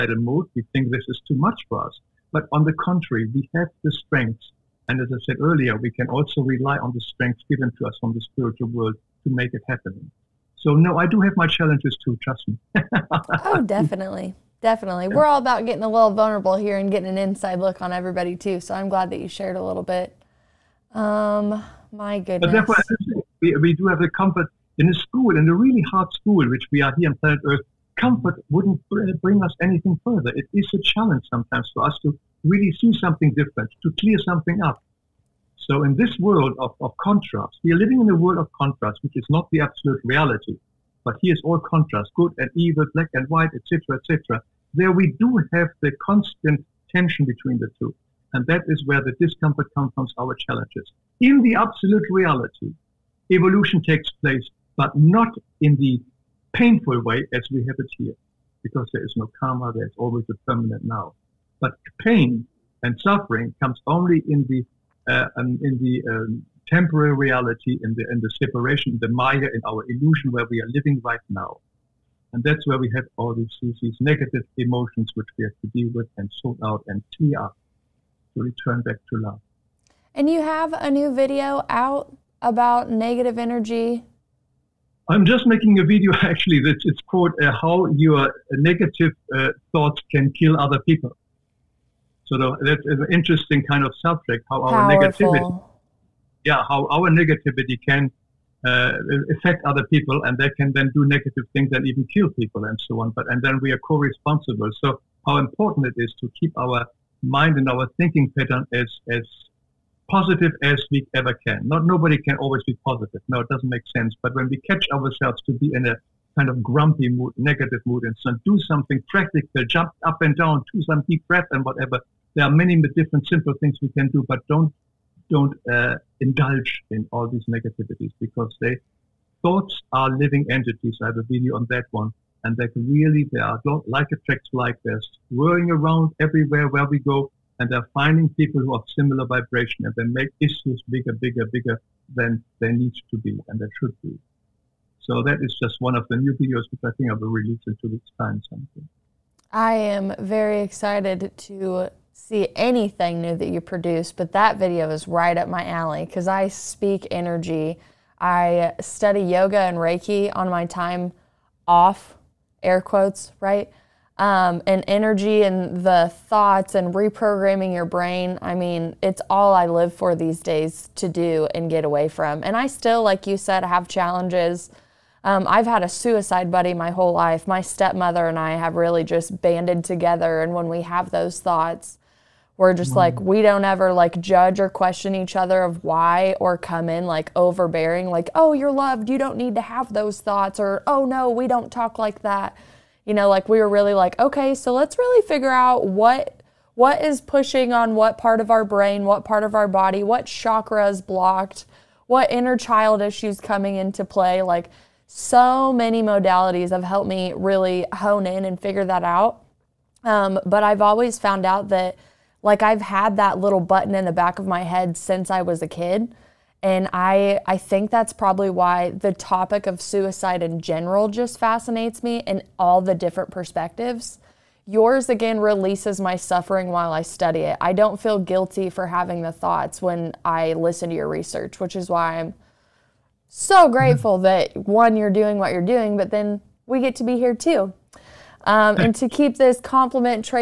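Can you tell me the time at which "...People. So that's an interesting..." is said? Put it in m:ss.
1:30.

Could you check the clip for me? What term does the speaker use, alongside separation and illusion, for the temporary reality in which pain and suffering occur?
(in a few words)
Maya.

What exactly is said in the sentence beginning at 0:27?
Comfort wouldn't bring us anything further.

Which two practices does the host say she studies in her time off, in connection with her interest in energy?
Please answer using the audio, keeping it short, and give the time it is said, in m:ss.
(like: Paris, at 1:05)
yoga and Reiki, at 2:39.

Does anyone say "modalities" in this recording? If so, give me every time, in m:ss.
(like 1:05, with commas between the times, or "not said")
3:26.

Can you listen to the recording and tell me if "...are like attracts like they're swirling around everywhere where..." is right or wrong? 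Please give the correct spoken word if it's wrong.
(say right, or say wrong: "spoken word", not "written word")
right.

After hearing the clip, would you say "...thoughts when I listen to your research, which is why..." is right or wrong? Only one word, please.
right.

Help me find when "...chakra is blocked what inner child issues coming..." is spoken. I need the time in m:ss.
3:20.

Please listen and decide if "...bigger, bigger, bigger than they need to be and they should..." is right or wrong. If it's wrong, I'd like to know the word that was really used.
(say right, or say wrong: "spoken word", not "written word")
right.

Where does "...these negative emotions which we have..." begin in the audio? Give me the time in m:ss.
1:13.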